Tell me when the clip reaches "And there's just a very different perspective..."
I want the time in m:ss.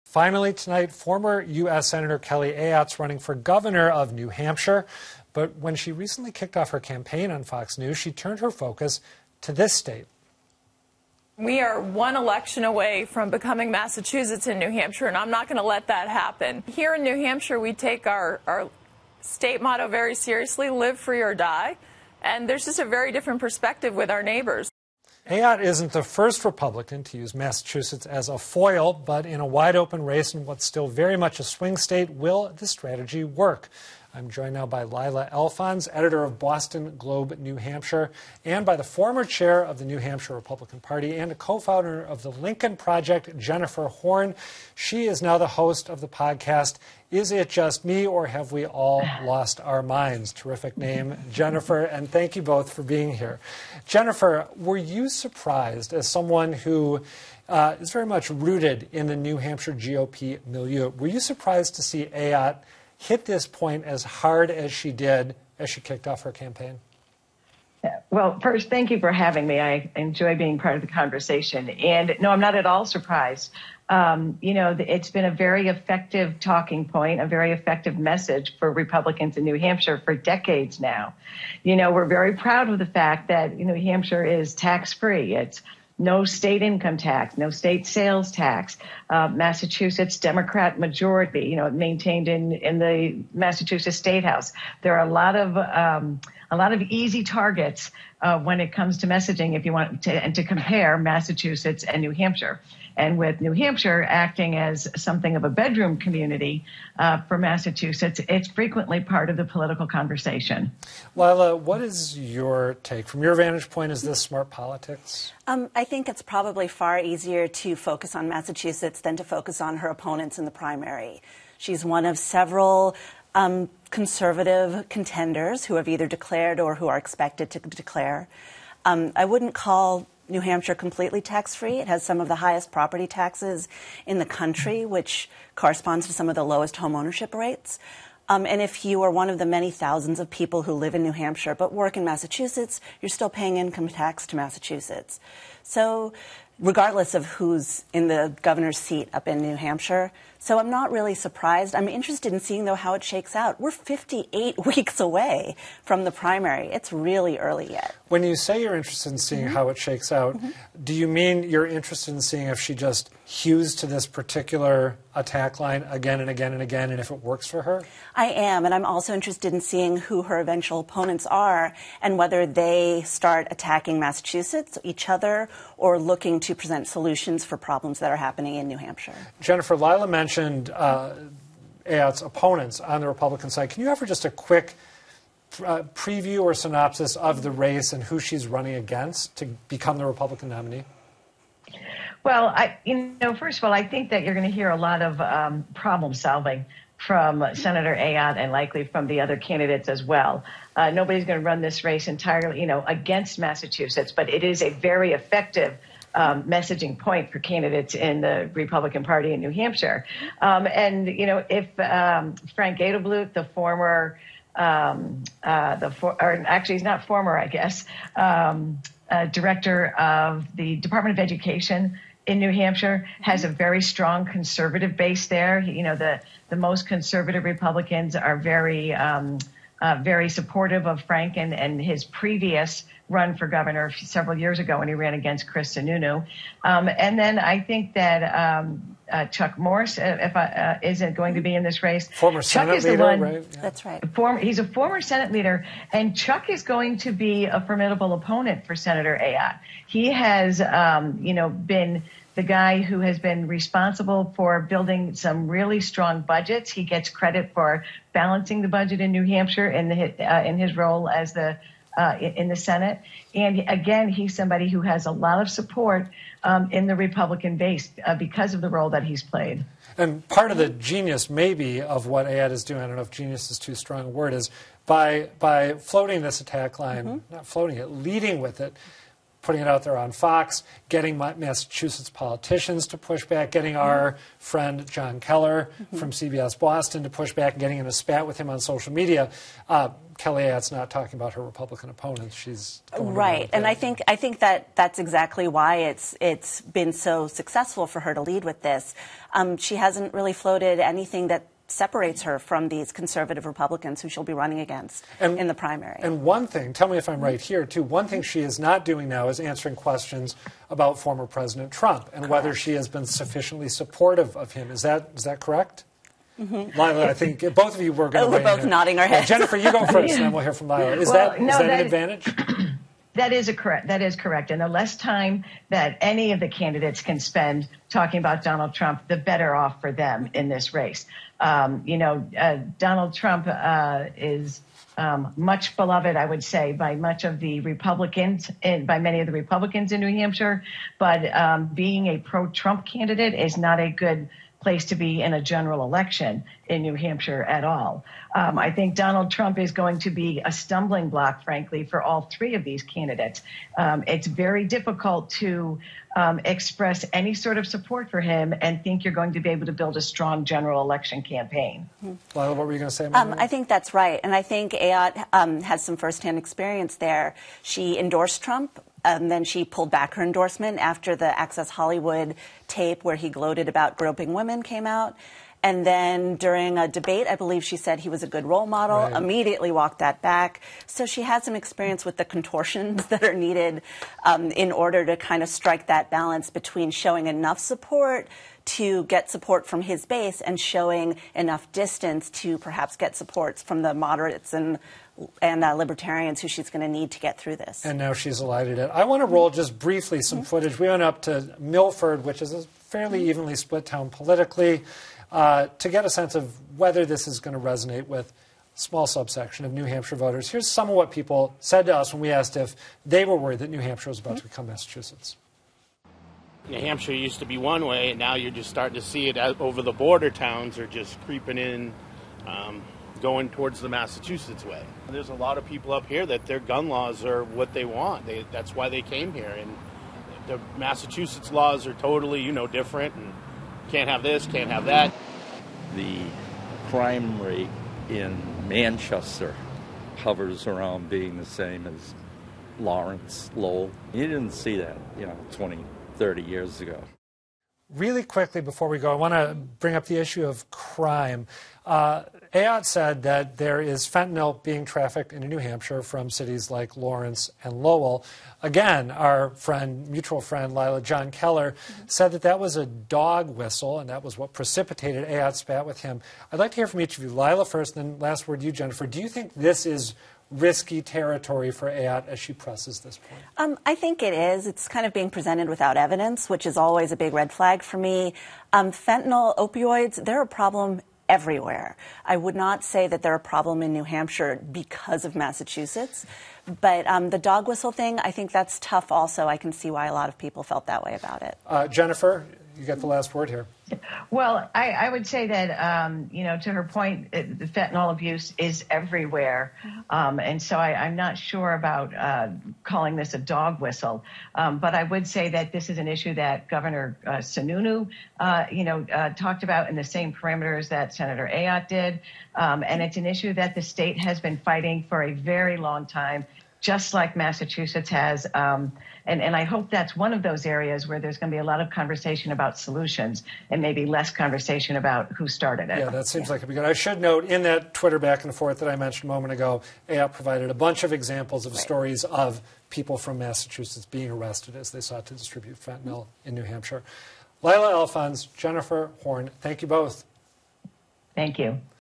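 0:22.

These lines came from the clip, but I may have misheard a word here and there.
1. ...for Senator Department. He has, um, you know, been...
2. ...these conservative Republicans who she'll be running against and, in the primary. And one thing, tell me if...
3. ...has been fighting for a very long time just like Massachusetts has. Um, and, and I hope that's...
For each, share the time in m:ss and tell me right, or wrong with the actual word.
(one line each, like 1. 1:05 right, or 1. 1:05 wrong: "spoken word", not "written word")
1. 4:08 wrong: "Ayotte", not "Department"
2. 5:02 right
3. 8:34 right.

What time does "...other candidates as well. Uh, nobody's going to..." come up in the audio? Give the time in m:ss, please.
3:19.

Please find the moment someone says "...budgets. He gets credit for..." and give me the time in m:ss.
4:16.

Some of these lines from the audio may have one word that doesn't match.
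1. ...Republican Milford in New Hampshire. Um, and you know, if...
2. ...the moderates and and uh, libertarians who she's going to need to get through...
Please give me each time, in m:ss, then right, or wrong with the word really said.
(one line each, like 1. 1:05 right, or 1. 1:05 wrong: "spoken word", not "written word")
1. 3:28 wrong: "Party", not "Milford"
2. 6:33 right.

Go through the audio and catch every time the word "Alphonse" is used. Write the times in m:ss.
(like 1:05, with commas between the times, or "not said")
0:35, 8:57.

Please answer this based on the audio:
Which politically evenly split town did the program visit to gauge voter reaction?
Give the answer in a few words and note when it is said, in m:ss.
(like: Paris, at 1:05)
Milford, at 6:41.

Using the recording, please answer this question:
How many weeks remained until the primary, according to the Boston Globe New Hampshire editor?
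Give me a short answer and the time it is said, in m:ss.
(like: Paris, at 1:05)
58, at 2:33.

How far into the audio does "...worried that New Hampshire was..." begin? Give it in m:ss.
6:53.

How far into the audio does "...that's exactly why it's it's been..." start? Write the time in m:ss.
4:54.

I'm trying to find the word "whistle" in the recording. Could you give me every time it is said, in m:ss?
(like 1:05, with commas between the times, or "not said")
7:43, 8:07, 8:23.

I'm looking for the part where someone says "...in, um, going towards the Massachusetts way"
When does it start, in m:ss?
7:01.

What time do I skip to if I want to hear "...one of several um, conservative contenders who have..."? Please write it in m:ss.
2:01.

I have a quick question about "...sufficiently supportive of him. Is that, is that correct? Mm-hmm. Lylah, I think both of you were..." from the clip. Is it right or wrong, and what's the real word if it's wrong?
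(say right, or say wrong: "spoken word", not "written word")
right.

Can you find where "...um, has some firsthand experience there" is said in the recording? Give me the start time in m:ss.
6:05.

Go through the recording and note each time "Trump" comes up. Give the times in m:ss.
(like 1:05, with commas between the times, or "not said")
5:11, 5:28, 5:33, 5:42, 5:49, 6:08.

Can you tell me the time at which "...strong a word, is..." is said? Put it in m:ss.
4:33.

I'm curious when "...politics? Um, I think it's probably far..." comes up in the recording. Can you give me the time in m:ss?
1:54.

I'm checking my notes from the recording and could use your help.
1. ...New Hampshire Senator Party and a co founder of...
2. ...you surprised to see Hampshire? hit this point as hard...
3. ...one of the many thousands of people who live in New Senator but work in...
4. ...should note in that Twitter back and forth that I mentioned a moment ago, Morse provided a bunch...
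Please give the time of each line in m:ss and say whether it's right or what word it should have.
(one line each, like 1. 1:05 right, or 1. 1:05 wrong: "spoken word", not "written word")
1. 0:39 wrong: "Republican", not "Senator"
2. 1:01 wrong: "Ayotte", not "Hampshire"
3. 2:19 wrong: "Hampshire", not "Senator"
4. 8:46 wrong: "Ayotte", not "Morse".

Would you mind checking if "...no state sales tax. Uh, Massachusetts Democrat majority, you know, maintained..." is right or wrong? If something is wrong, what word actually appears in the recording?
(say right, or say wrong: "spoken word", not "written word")
right.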